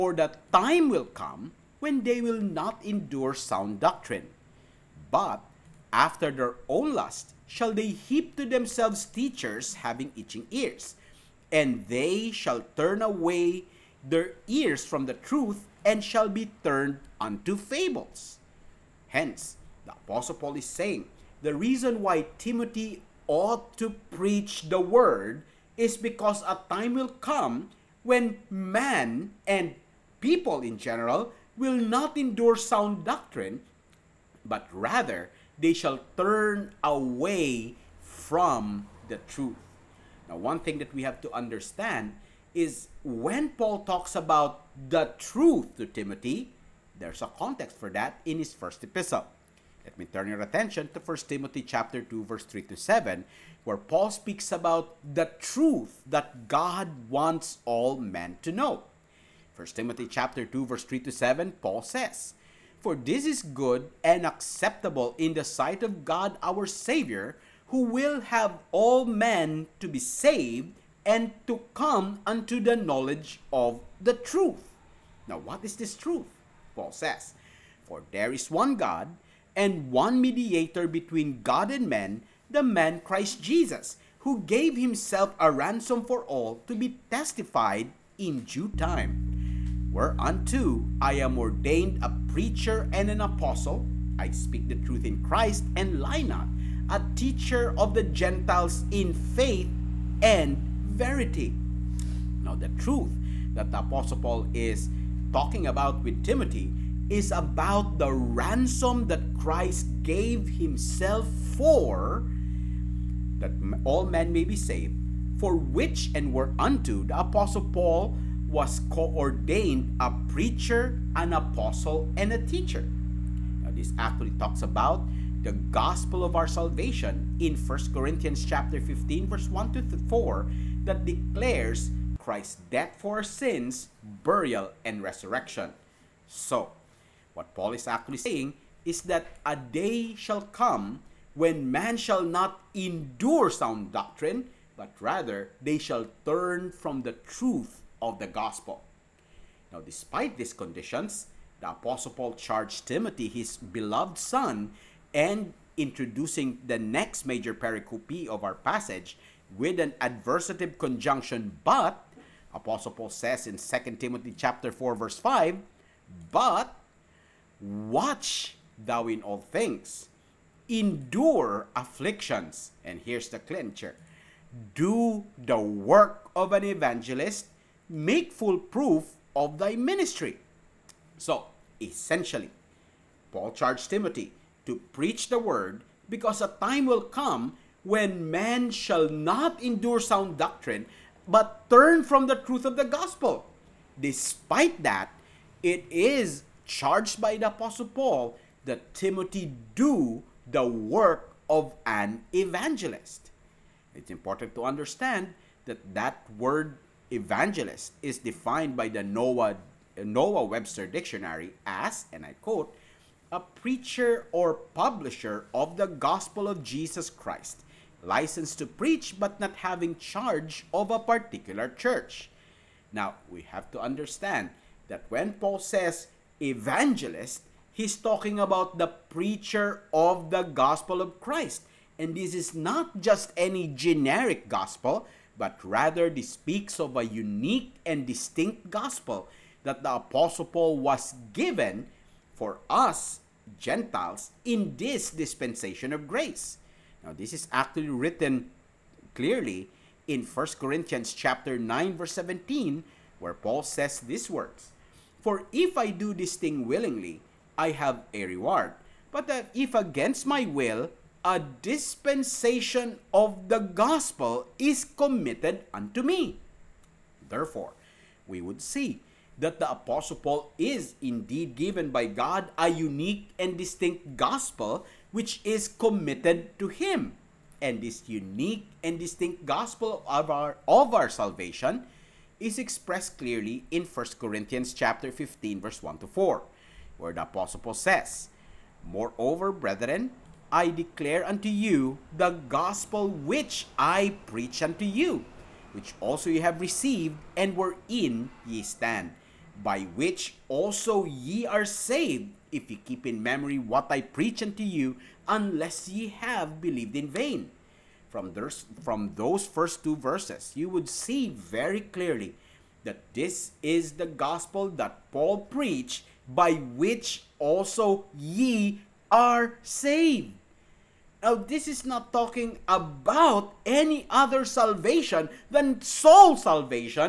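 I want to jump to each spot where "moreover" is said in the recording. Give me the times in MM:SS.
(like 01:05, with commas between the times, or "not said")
04:48.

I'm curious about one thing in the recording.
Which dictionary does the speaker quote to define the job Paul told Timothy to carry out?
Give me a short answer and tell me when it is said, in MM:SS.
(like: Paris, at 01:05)
Noah Webster Dictionary, at 03:29.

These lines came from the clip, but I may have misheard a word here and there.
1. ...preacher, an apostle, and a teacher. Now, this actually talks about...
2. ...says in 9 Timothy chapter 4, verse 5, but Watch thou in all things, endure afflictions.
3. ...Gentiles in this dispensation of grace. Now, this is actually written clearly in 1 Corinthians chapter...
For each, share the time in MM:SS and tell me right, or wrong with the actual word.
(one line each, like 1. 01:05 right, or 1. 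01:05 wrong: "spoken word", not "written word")
1. 02:00 right
2. 02:43 wrong: "2", not "9"
3. 04:03 right.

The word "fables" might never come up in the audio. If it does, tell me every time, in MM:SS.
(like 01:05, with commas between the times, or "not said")
00:17.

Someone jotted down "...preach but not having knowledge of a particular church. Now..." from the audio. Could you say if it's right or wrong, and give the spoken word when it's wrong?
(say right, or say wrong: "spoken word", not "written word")
wrong: "charge", not "knowledge".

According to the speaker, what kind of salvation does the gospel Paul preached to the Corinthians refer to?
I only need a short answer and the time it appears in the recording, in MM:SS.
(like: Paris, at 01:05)
soul salvation, at 05:25.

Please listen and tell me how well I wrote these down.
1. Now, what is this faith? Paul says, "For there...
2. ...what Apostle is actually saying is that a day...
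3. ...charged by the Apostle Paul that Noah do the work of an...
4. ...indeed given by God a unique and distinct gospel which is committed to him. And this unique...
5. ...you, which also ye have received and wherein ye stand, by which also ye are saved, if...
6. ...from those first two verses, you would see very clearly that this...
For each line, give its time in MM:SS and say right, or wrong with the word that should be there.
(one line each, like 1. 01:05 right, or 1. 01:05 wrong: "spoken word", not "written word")
1. 01:15 wrong: "truth", not "faith"
2. 02:17 wrong: "Paul", not "Apostle"
3. 03:16 wrong: "Timothy", not "Noah"
4. 04:30 right
5. 04:54 right
6. 05:08 right.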